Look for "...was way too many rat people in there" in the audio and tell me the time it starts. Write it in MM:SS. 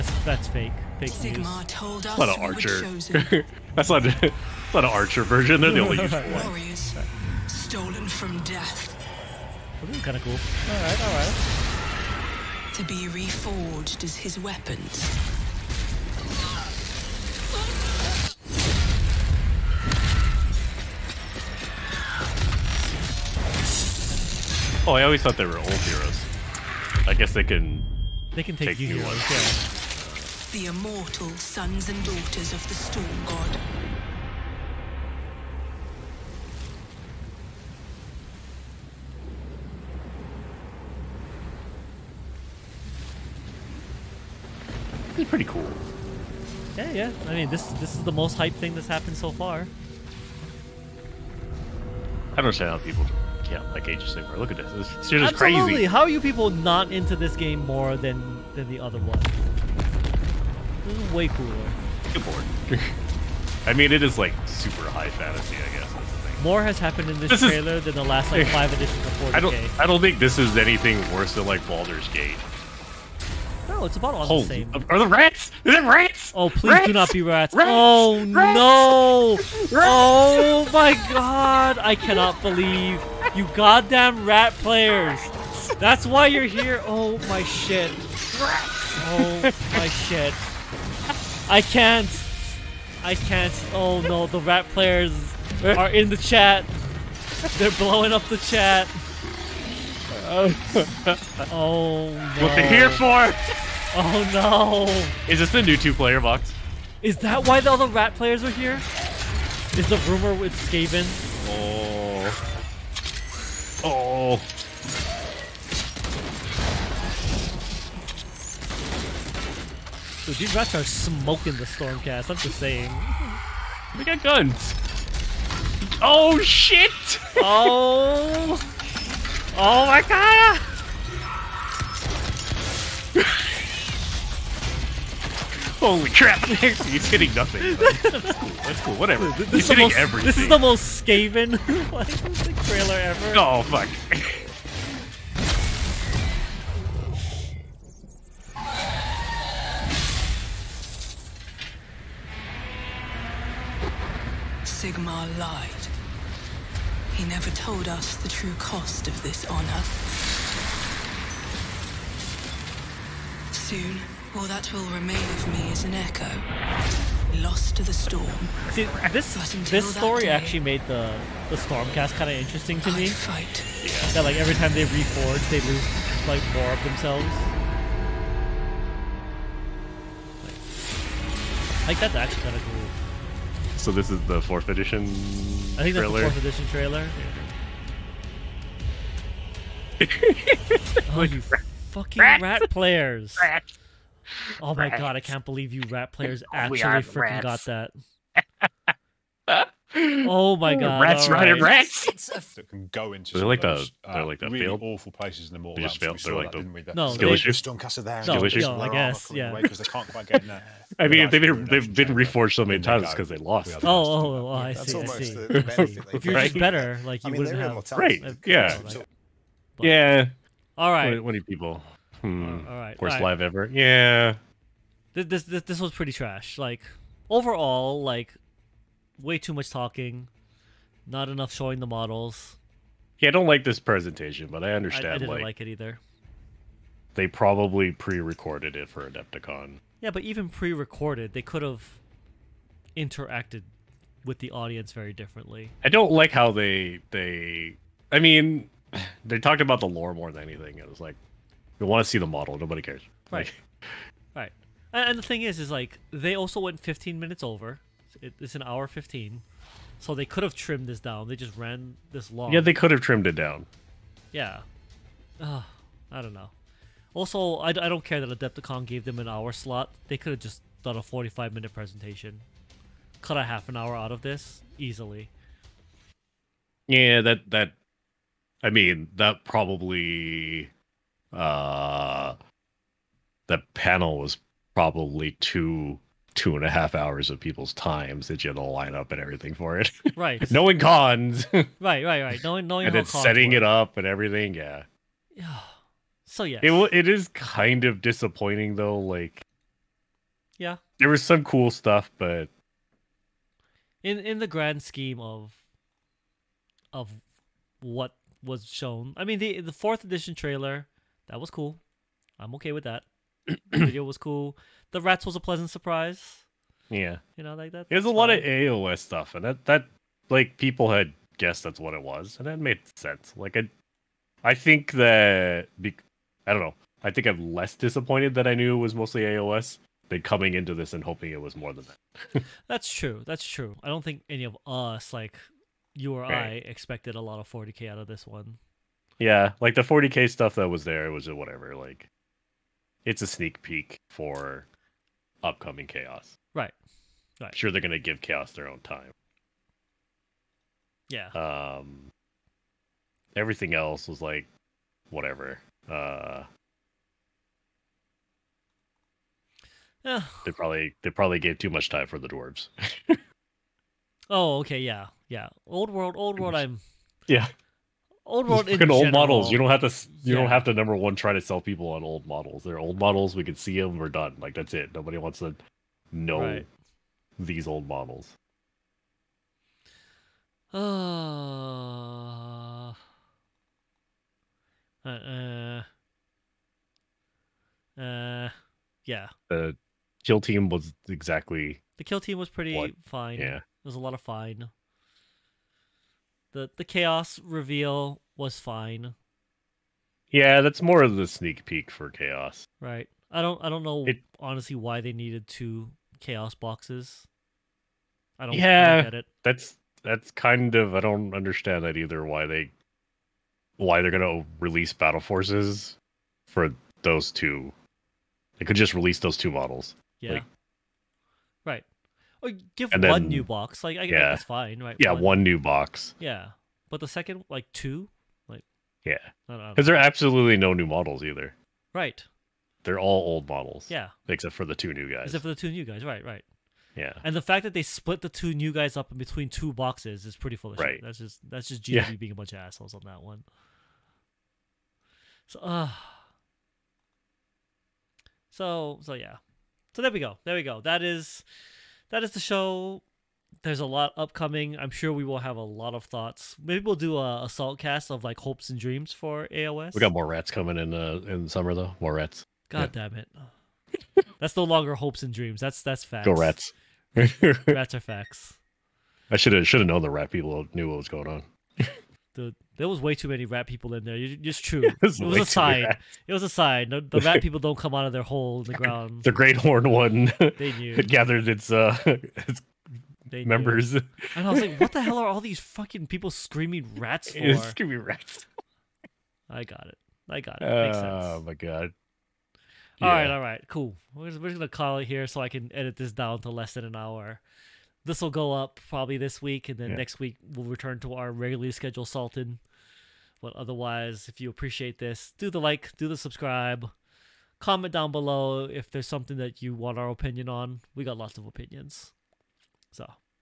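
07:52.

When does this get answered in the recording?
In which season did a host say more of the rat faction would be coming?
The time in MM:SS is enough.
07:41.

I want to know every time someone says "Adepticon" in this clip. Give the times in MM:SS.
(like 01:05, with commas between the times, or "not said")
03:59, 04:28.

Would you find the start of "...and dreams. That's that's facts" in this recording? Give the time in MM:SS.
07:45.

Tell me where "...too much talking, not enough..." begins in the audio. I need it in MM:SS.
03:49.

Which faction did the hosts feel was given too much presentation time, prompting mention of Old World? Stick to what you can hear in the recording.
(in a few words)
The dwarves.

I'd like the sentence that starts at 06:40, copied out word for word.
Yeah, that's more of the sneak peek for chaos.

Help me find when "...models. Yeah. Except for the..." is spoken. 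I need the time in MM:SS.
07:13.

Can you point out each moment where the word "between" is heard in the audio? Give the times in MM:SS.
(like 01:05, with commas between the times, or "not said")
07:19.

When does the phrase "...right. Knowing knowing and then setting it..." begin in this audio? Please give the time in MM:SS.
04:52.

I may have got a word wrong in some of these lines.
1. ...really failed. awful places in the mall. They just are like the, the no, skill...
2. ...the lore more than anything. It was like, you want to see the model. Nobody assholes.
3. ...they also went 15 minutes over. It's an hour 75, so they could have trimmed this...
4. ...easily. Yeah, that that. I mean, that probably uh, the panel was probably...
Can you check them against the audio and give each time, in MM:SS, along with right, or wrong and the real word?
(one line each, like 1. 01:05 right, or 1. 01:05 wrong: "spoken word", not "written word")
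1. 03:24 right
2. 04:09 wrong: "cares", not "assholes"
3. 04:16 wrong: "15", not "75"
4. 04:34 right.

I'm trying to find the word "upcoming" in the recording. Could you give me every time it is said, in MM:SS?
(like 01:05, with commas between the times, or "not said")
05:45, 07:34.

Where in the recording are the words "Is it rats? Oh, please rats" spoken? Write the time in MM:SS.
01:15.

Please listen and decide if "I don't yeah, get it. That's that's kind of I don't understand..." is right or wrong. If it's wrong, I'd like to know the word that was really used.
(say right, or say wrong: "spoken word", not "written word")
right.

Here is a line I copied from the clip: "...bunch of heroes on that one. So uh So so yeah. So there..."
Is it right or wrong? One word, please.
wrong.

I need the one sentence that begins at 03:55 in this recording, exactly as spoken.
I, I didn't like, like, it either.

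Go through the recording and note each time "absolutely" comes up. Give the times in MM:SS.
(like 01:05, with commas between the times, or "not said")
00:55, 07:09.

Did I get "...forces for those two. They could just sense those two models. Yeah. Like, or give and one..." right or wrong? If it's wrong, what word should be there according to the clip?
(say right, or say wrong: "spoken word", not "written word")
wrong: "release", not "sense".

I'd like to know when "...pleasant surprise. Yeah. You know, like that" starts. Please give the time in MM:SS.
05:15.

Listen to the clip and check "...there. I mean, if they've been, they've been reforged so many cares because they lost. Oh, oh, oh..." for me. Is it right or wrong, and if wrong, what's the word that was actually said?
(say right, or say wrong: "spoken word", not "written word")
wrong: "times", not "cares".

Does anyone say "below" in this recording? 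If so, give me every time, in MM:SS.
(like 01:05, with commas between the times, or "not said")
08:28.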